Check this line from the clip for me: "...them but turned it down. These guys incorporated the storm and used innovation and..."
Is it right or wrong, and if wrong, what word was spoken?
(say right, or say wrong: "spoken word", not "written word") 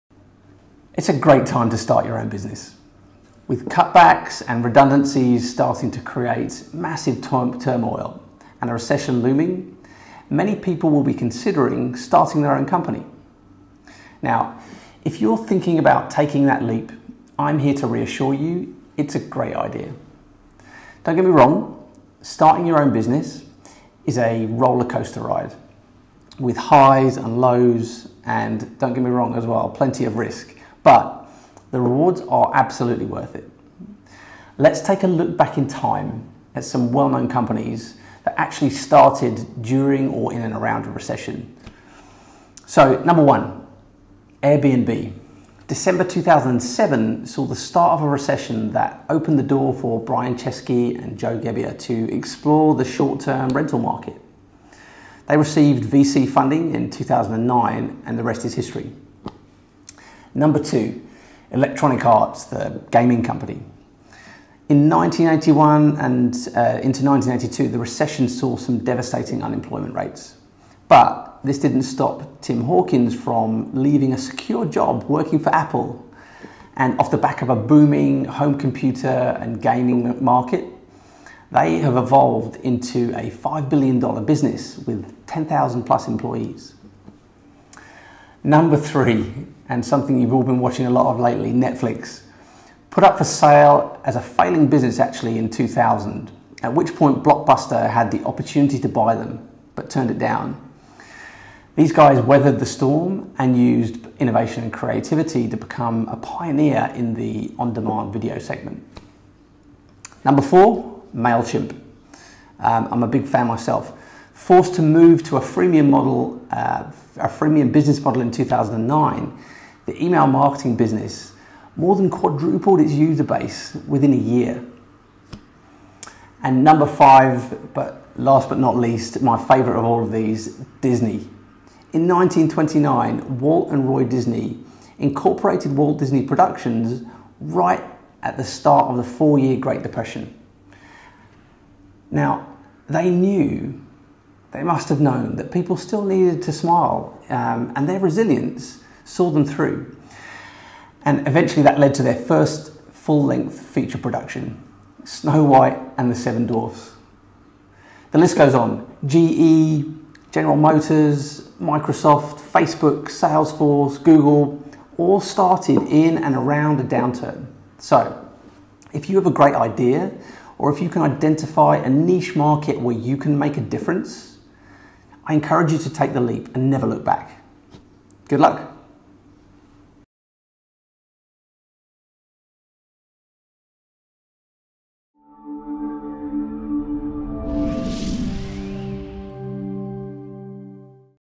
wrong: "weathered", not "incorporated".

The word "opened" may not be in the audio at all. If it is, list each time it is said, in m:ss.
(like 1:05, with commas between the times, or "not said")
0:49.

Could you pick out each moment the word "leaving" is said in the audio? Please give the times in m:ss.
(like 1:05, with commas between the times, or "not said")
1:13.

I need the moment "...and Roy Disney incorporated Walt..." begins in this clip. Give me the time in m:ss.
2:13.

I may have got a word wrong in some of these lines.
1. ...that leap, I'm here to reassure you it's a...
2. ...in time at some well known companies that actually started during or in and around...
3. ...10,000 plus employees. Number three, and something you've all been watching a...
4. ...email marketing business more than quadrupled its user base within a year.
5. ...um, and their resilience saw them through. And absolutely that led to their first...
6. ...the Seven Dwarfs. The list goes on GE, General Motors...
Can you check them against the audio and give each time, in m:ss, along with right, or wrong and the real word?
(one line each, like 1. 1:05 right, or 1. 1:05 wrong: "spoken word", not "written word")
1. 0:16 right
2. 0:35 right
3. 1:25 right
4. 2:00 right
5. 2:27 wrong: "eventually", not "absolutely"
6. 2:36 right.